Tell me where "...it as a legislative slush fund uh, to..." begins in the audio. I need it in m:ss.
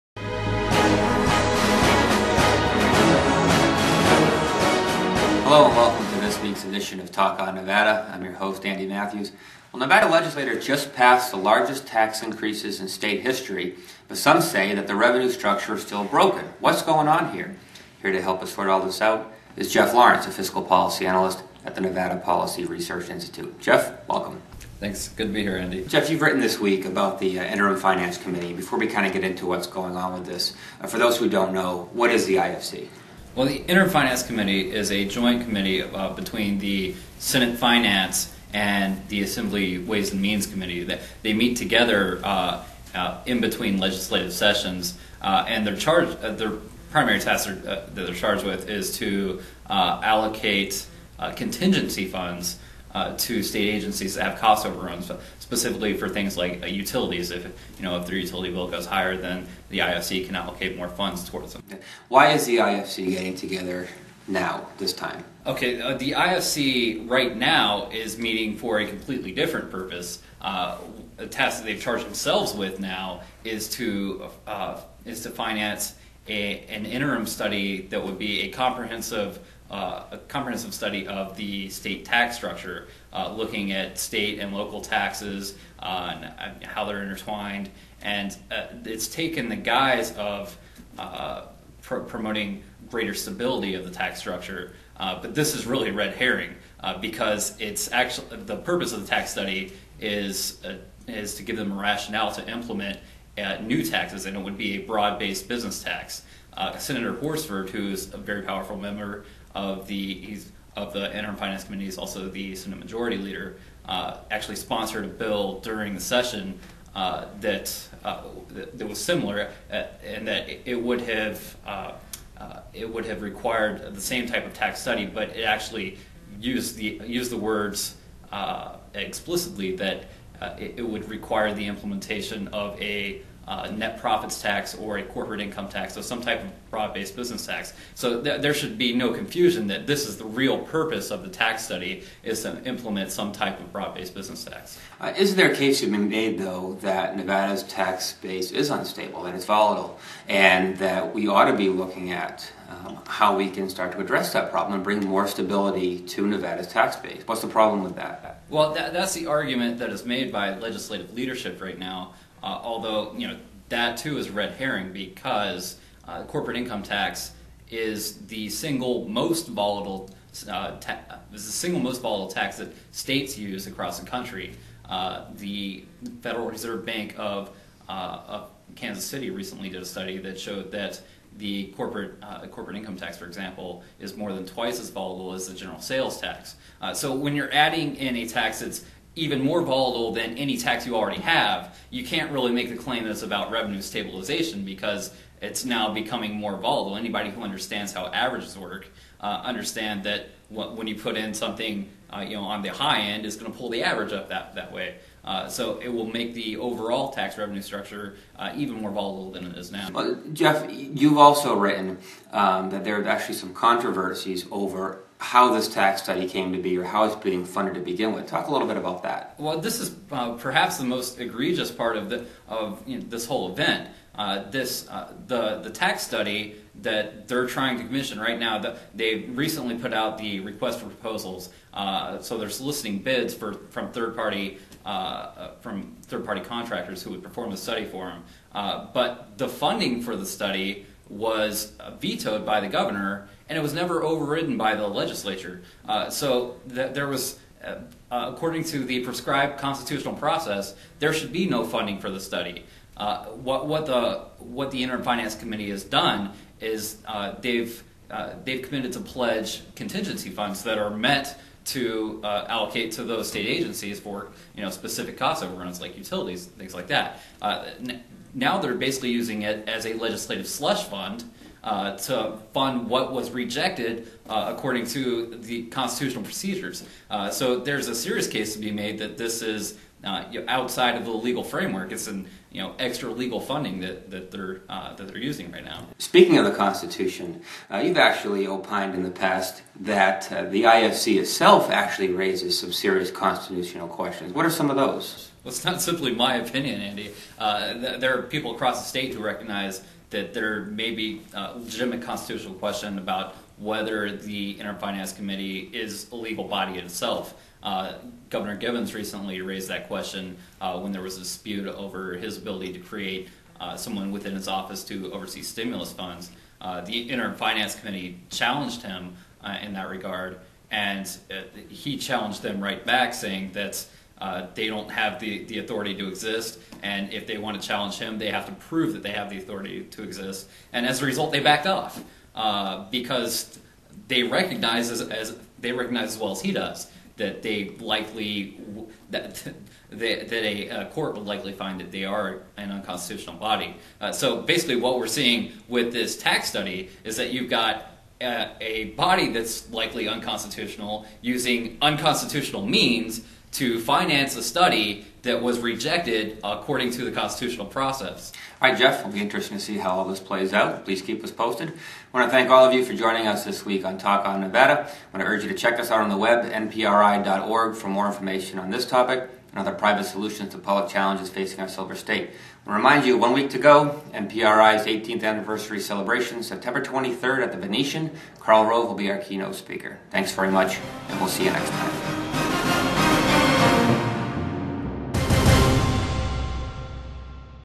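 4:29.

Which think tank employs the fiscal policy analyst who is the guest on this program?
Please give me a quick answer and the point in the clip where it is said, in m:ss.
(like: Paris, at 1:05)
Nevada Policy Research Institute, at 0:21.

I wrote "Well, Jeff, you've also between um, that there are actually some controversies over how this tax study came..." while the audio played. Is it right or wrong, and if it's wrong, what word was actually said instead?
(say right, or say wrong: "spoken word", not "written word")
wrong: "written", not "between".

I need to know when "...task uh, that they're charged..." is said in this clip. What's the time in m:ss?
0:47.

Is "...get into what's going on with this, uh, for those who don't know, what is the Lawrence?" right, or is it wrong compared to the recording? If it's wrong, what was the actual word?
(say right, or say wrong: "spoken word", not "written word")
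wrong: "IFC", not "Lawrence".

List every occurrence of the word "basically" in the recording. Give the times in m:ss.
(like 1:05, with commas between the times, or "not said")
4:28, 5:44.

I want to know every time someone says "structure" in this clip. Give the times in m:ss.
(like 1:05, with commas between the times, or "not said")
0:15, 1:22, 1:34, 3:27.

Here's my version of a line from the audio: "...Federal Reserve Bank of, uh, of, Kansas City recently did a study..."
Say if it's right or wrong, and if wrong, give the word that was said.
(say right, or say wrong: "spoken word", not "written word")
right.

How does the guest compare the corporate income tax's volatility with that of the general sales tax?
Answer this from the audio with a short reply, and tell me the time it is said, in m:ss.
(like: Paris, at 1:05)
more than twice, at 3:04.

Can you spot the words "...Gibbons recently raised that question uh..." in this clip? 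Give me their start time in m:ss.
5:08.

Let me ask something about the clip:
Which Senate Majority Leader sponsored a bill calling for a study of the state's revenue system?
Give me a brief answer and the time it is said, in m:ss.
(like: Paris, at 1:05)
Senator Horsford, at 1:46.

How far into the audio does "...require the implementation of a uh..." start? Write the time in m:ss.
2:11.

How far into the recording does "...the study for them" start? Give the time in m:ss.
3:57.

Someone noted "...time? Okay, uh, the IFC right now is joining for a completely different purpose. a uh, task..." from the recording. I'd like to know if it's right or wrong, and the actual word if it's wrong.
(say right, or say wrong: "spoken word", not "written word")
wrong: "meeting", not "joining".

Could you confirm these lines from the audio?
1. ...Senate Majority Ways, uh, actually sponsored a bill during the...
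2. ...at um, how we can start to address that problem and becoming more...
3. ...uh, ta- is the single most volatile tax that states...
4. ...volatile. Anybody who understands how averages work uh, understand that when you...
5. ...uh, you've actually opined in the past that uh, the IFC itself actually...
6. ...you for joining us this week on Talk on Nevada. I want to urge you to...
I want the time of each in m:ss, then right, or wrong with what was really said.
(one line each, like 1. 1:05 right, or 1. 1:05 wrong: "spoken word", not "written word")
1. 1:52 wrong: "Leader", not "Ways"
2. 2:32 wrong: "bring", not "becoming"
3. 2:50 right
4. 3:16 right
5. 4:47 right
6. 6:02 right.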